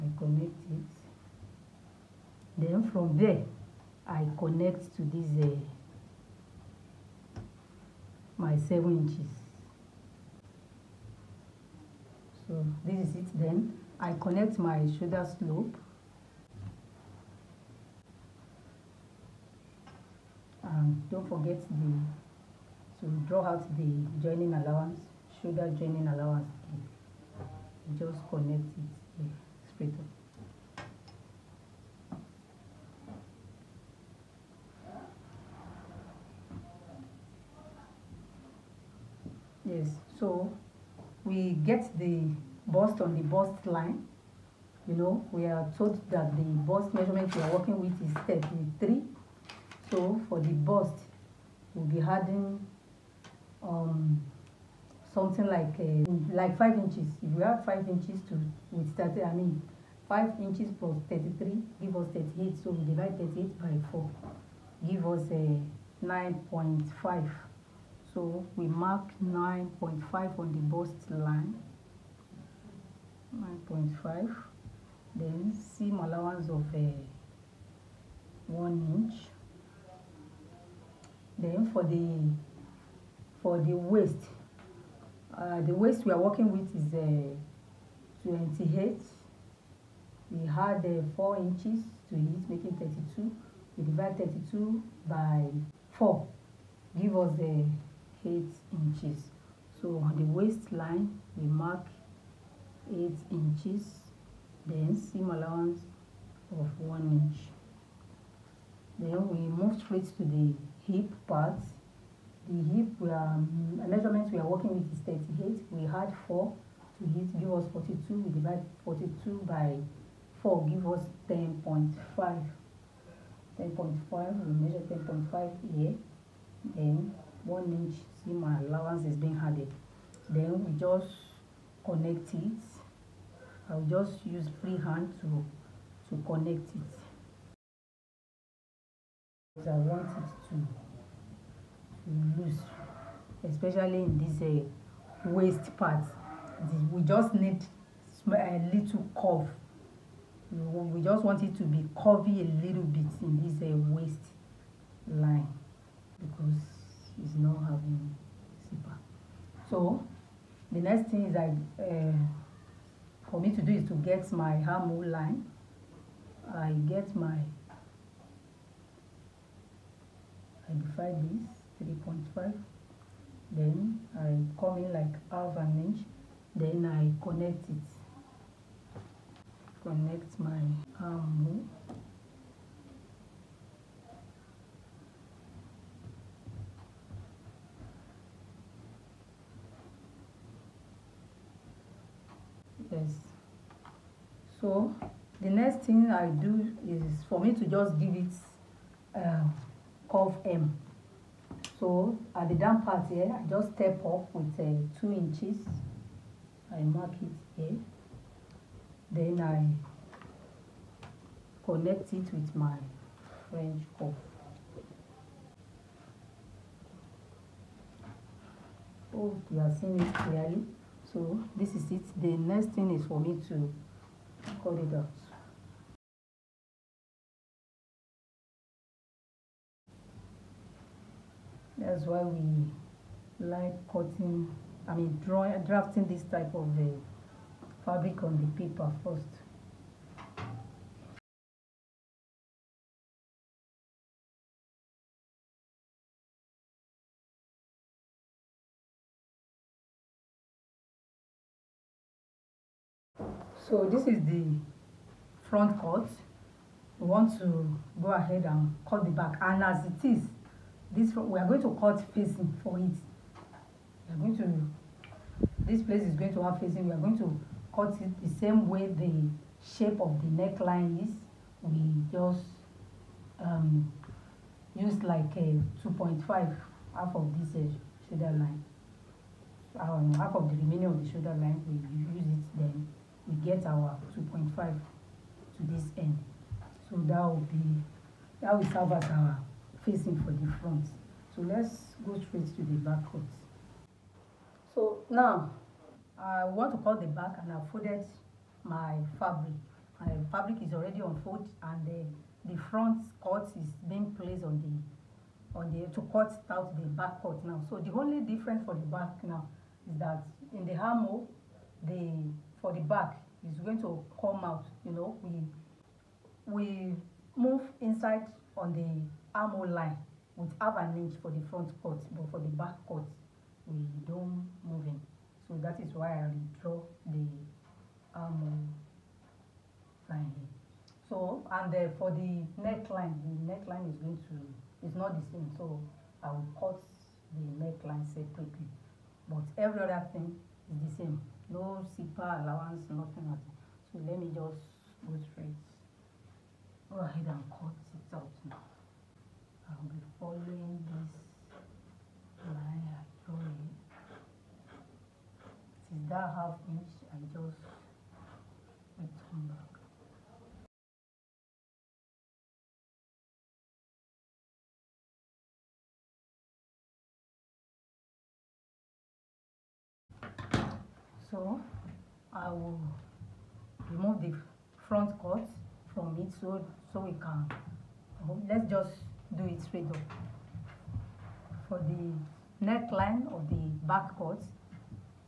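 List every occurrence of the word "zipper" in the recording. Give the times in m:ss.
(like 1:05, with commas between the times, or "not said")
2:38, 5:41.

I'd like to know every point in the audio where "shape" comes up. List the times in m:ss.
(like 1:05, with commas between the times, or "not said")
4:29.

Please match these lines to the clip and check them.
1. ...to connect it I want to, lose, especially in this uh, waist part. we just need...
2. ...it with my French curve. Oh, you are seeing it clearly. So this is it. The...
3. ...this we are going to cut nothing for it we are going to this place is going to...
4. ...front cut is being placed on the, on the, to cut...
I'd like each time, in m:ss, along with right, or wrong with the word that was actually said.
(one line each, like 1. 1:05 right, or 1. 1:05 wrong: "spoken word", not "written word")
1. 2:16 right
2. 3:32 right
3. 4:20 wrong: "facing", not "nothing"
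4. 5:02 right.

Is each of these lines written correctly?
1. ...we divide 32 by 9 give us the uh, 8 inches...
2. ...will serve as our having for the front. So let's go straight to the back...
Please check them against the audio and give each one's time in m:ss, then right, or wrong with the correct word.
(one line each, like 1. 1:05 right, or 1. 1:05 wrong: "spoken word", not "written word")
1. 1:33 wrong: "4", not "9"
2. 4:48 wrong: "facing", not "having".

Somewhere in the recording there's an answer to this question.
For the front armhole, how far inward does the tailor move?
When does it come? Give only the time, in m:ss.
2:55.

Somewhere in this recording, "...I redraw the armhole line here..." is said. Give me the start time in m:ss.
5:26.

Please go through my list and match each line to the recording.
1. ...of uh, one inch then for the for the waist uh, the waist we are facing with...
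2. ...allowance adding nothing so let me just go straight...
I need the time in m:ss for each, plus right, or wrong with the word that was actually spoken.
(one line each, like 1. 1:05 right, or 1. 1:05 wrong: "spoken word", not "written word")
1. 1:16 wrong: "working", not "facing"
2. 5:42 wrong: "nothing", not "adding".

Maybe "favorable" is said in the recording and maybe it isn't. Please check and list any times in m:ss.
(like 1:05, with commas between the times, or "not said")
not said.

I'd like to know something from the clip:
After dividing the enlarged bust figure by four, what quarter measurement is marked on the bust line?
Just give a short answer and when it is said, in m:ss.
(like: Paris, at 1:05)
9.5, at 1:05.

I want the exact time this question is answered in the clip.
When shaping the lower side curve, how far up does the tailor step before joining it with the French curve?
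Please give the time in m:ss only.
3:24.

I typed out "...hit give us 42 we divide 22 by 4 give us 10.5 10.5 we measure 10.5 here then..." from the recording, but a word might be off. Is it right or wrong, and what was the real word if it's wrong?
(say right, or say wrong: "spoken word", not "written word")
wrong: "42", not "22".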